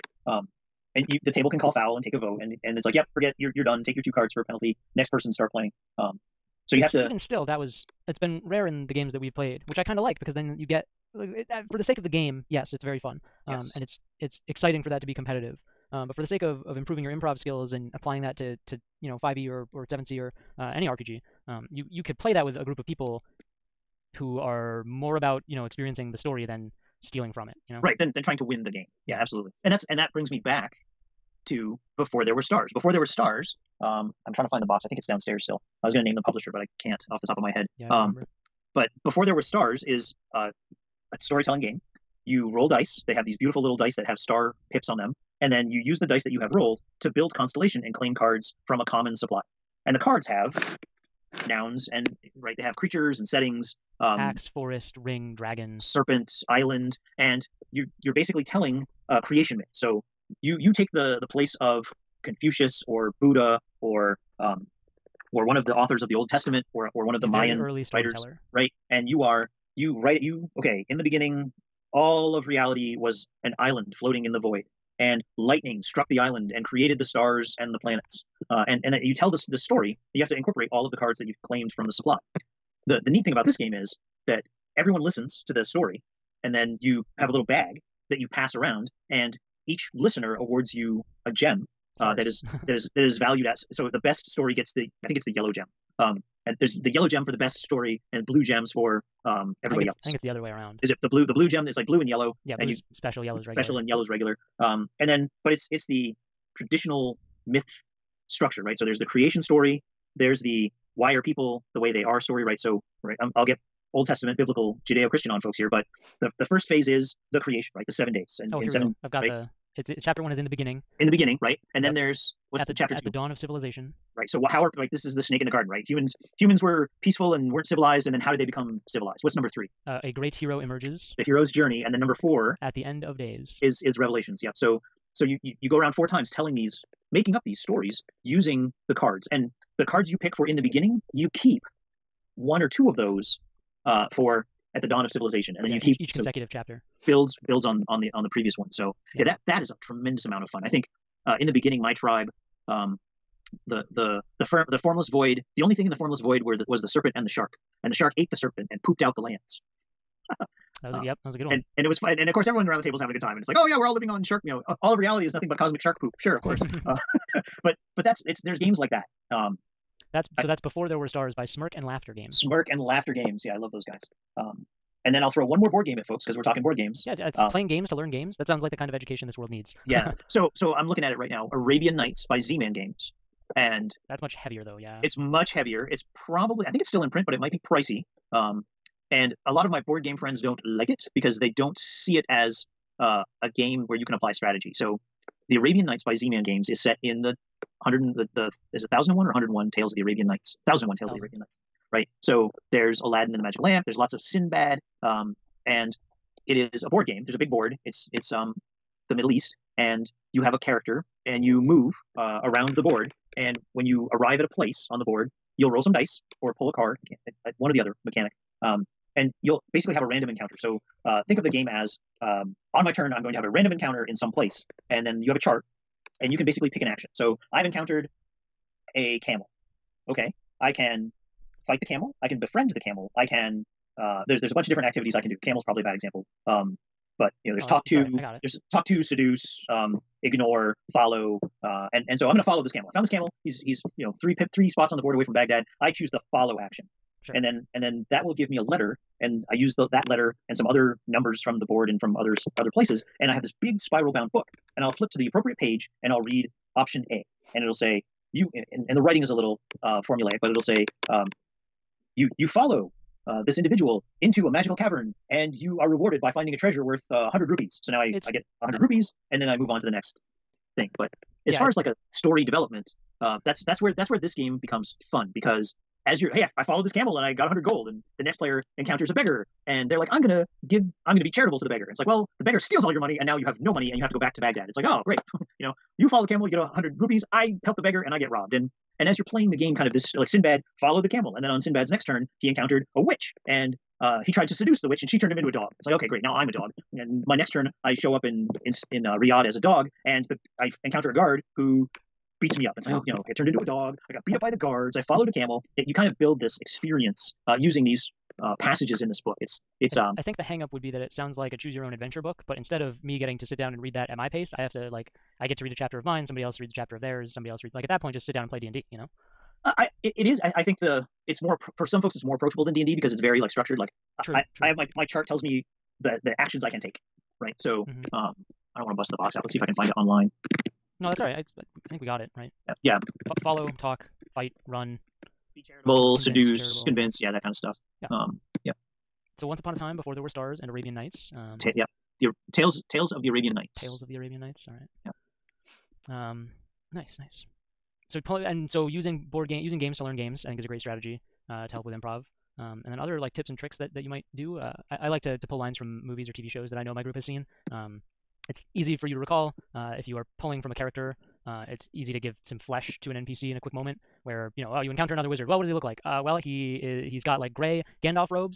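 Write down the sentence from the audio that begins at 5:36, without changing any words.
convince, yeah, that kind of stuff.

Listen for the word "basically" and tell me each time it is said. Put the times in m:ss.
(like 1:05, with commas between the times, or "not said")
0:58, 3:39, 3:46.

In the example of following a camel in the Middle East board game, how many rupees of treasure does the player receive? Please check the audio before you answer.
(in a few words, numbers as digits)
100.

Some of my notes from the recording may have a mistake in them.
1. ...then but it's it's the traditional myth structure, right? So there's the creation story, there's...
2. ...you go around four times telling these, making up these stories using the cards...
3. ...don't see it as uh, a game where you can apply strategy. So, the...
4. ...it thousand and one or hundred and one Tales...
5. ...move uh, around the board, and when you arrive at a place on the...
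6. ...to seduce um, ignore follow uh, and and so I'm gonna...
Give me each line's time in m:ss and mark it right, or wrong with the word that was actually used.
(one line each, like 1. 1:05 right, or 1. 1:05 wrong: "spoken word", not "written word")
1. 1:45 right
2. 2:15 right
3. 3:11 right
4. 3:18 right
5. 3:31 right
6. 3:58 right.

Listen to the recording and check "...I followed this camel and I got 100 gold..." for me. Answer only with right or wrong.
right.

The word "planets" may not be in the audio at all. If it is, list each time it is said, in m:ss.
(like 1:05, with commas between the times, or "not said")
1:17.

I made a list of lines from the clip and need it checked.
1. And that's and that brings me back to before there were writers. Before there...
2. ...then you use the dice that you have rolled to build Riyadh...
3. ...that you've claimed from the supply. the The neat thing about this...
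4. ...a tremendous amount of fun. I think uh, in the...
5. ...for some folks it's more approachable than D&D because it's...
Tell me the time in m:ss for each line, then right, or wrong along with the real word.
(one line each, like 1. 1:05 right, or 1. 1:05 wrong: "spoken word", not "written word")
1. 0:29 wrong: "stars", not "writers"
2. 0:45 wrong: "Constellation", not "Riyadh"
3. 1:21 right
4. 2:29 right
5. 5:21 right.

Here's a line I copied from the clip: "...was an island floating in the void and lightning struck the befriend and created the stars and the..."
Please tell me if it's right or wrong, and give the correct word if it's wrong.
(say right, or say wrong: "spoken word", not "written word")
wrong: "island", not "befriend".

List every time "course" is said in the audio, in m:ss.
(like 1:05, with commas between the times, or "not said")
2:42, 2:46.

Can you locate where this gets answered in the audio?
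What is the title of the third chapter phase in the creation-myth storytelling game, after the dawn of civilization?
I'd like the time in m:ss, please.
2:10.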